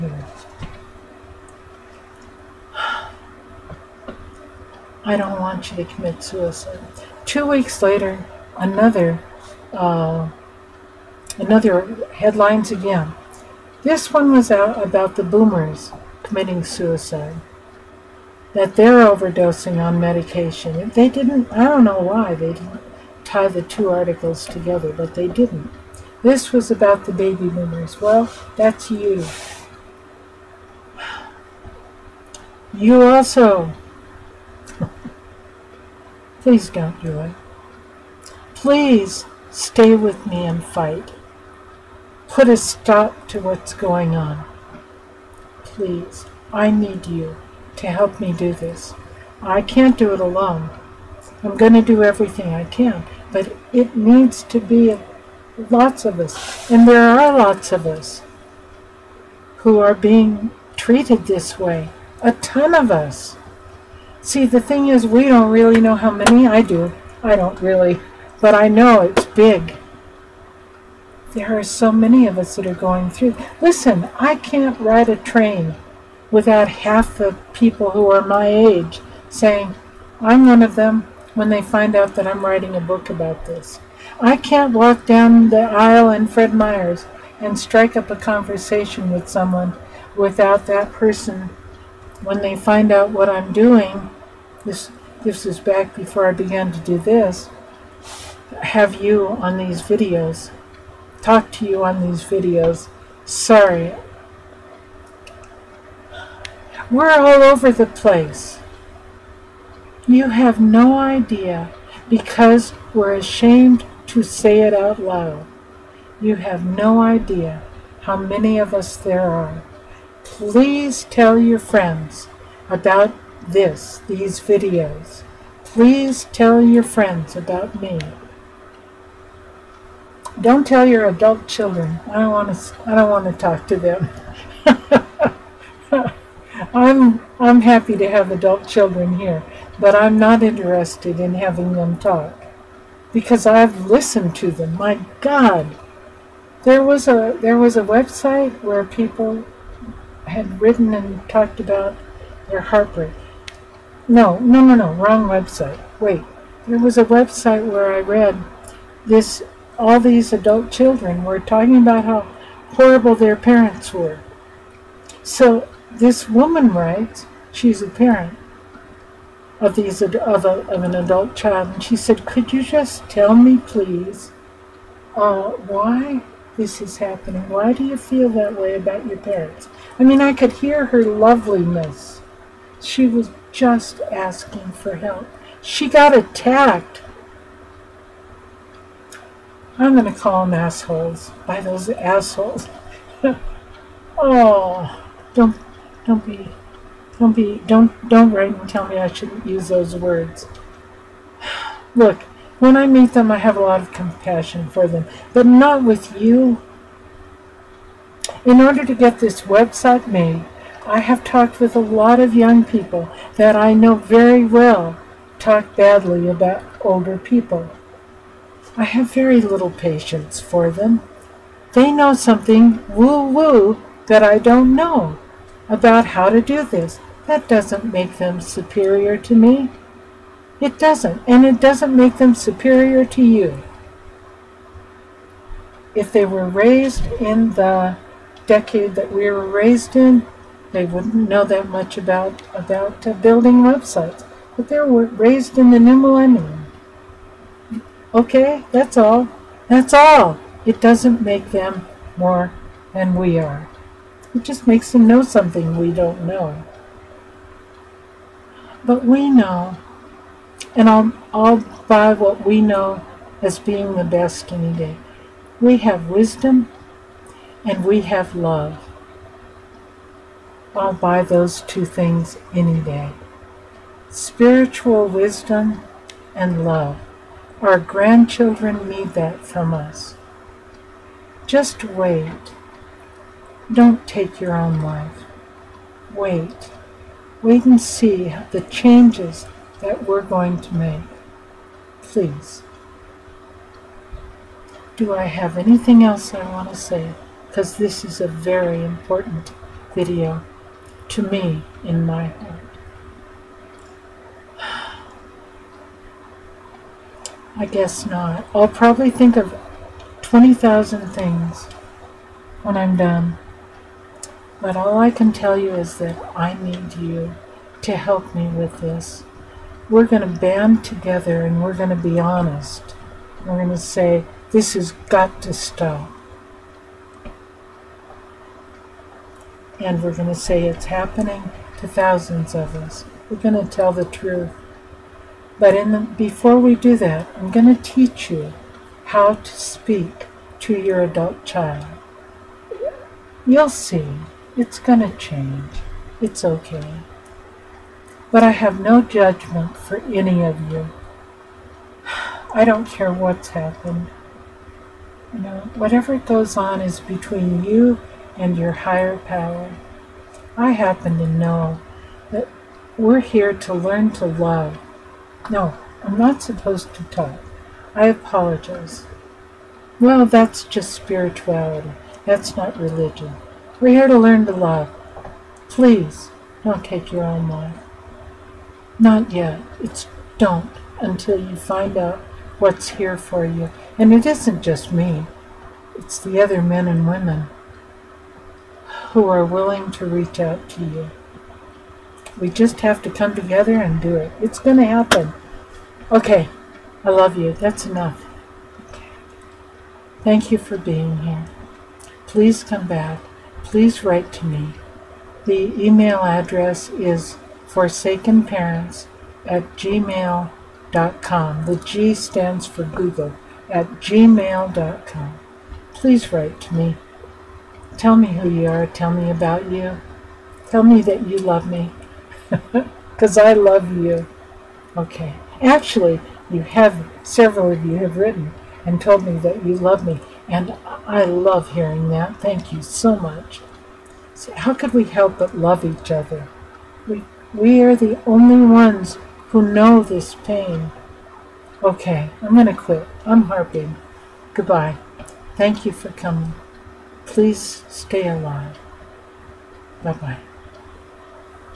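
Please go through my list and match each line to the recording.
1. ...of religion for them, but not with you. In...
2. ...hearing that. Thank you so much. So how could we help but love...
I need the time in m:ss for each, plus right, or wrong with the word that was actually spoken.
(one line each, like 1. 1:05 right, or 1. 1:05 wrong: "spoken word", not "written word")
1. 3:23 wrong: "compassion", not "religion"
2. 7:11 right.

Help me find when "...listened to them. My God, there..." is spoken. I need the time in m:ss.
2:23.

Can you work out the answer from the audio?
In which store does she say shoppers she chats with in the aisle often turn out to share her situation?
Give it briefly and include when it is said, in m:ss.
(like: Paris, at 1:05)
Fred Meyer's, at 1:26.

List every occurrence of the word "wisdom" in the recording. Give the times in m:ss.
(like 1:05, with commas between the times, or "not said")
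4:26, 4:35.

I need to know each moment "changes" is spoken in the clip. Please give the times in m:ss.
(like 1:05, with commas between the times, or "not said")
4:48, 5:45.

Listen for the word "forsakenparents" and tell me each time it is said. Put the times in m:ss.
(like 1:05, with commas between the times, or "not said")
6:47.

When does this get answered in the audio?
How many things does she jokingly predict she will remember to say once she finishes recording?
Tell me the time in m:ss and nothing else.
5:10.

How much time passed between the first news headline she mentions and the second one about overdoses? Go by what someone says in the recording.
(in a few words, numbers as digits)
Two weeks.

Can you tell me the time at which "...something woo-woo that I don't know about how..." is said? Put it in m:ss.
3:42.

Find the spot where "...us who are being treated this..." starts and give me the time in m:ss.
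0:57.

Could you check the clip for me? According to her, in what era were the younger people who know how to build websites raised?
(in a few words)
The new millennium.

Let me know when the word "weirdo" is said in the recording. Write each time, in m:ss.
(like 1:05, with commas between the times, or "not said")
not said.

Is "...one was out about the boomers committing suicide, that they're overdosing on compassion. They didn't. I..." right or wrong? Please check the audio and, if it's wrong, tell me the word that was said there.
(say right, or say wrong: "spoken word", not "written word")
wrong: "medication", not "compassion".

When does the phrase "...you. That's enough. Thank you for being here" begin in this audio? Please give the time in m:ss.
6:37.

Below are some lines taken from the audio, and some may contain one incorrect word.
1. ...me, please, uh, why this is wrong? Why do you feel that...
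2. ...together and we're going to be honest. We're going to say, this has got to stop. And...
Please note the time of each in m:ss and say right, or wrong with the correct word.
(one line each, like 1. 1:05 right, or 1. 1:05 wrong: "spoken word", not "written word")
1. 2:53 wrong: "happening", not "wrong"
2. 5:20 right.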